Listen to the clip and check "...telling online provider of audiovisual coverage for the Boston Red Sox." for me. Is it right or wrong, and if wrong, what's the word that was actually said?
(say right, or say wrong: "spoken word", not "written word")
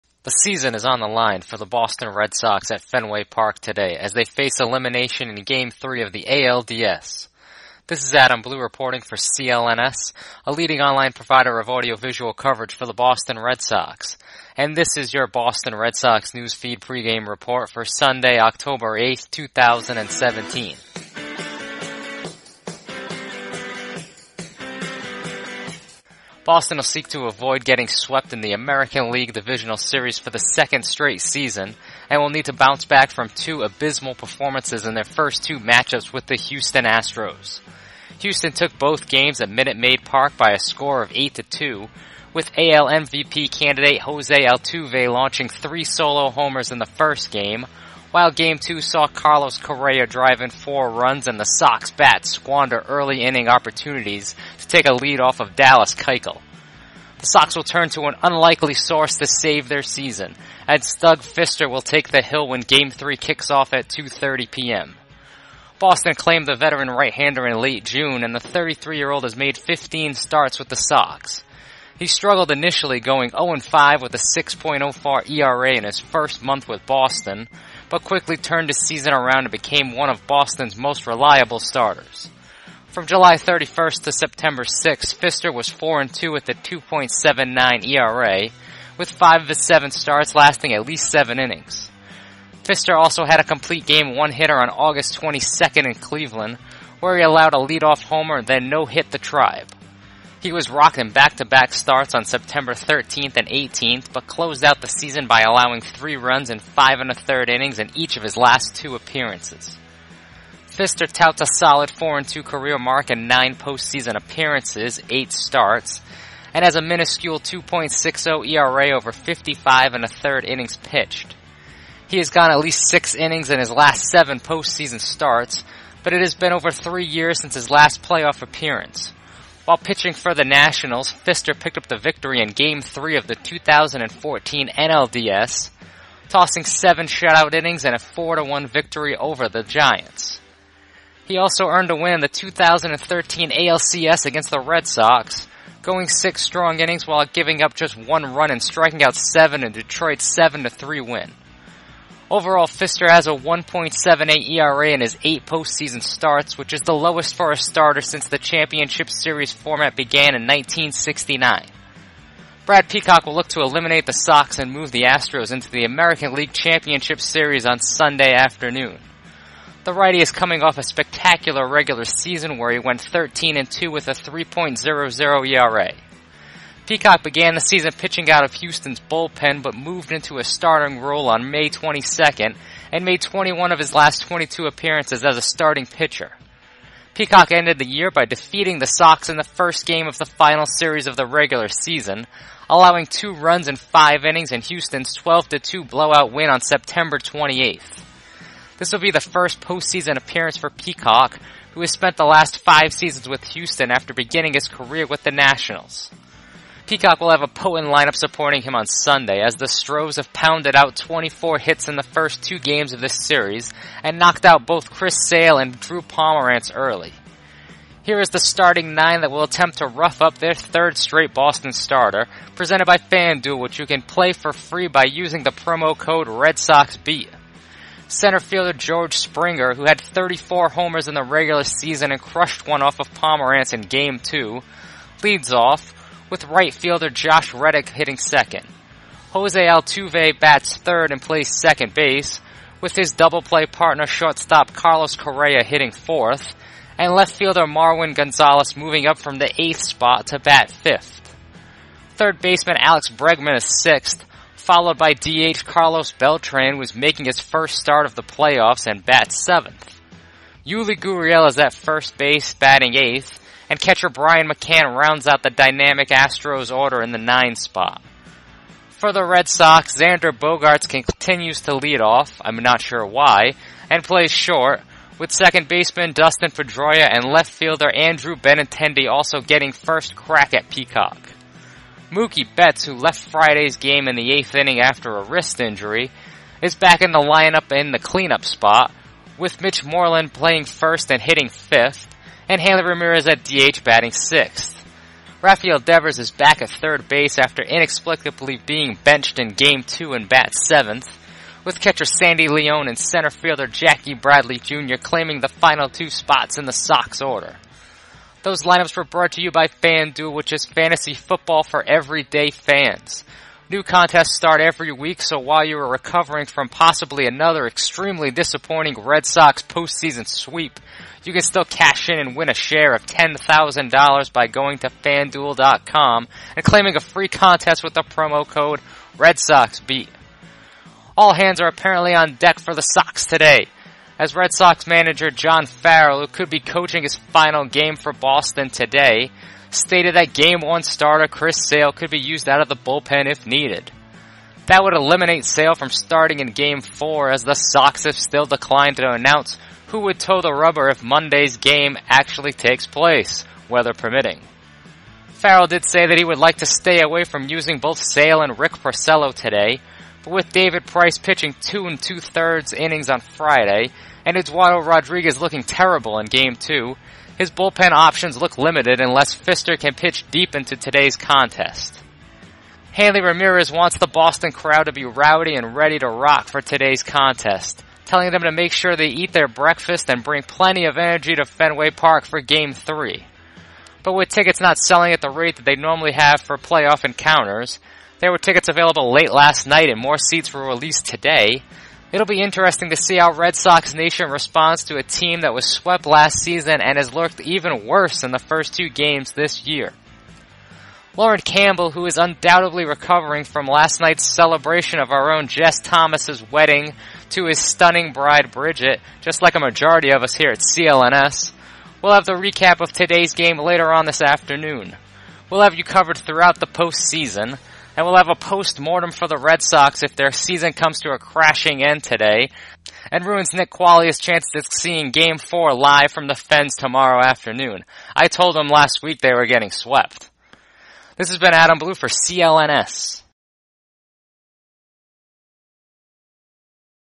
wrong: "leading", not "telling".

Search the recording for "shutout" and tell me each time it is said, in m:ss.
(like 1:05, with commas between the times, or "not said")
2:17.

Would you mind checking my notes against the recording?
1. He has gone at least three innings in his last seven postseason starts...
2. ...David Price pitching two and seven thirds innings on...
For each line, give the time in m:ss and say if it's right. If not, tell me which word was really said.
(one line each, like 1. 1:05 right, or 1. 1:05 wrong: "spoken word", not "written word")
1. 2:02 wrong: "six", not "three"
2. 6:00 wrong: "two", not "seven".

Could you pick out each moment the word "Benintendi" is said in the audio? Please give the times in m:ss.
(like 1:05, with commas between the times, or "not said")
4:38.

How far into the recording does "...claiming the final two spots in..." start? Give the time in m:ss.
5:05.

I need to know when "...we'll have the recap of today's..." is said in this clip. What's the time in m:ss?
6:52.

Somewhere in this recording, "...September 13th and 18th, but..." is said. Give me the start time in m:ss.
1:42.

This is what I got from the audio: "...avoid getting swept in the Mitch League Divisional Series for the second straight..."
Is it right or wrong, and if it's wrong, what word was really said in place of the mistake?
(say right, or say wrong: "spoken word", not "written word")
wrong: "American", not "Mitch".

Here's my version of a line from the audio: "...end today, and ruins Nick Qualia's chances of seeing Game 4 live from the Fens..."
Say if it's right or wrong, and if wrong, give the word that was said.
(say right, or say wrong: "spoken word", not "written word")
right.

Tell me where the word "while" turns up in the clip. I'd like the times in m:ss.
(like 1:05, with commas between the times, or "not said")
0:48, 2:09, 2:27, 5:15.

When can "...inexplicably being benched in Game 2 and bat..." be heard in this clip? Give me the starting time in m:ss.
4:57.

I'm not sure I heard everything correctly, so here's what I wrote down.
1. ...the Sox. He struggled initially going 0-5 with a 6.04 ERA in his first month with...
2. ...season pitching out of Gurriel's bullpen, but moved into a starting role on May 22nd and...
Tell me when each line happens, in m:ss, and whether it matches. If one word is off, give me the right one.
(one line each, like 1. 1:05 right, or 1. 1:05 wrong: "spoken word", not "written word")
1. 1:10 right
2. 2:57 wrong: "Houston", not "Gurriel".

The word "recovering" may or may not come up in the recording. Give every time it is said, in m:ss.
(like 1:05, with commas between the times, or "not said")
5:15, 6:42.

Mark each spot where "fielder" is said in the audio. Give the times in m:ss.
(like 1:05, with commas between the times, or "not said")
3:48, 3:56, 4:07, 4:37, 5:03.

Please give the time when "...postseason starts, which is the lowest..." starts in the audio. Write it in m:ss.
2:35.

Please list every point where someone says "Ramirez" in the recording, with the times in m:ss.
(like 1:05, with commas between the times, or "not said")
4:52, 6:13.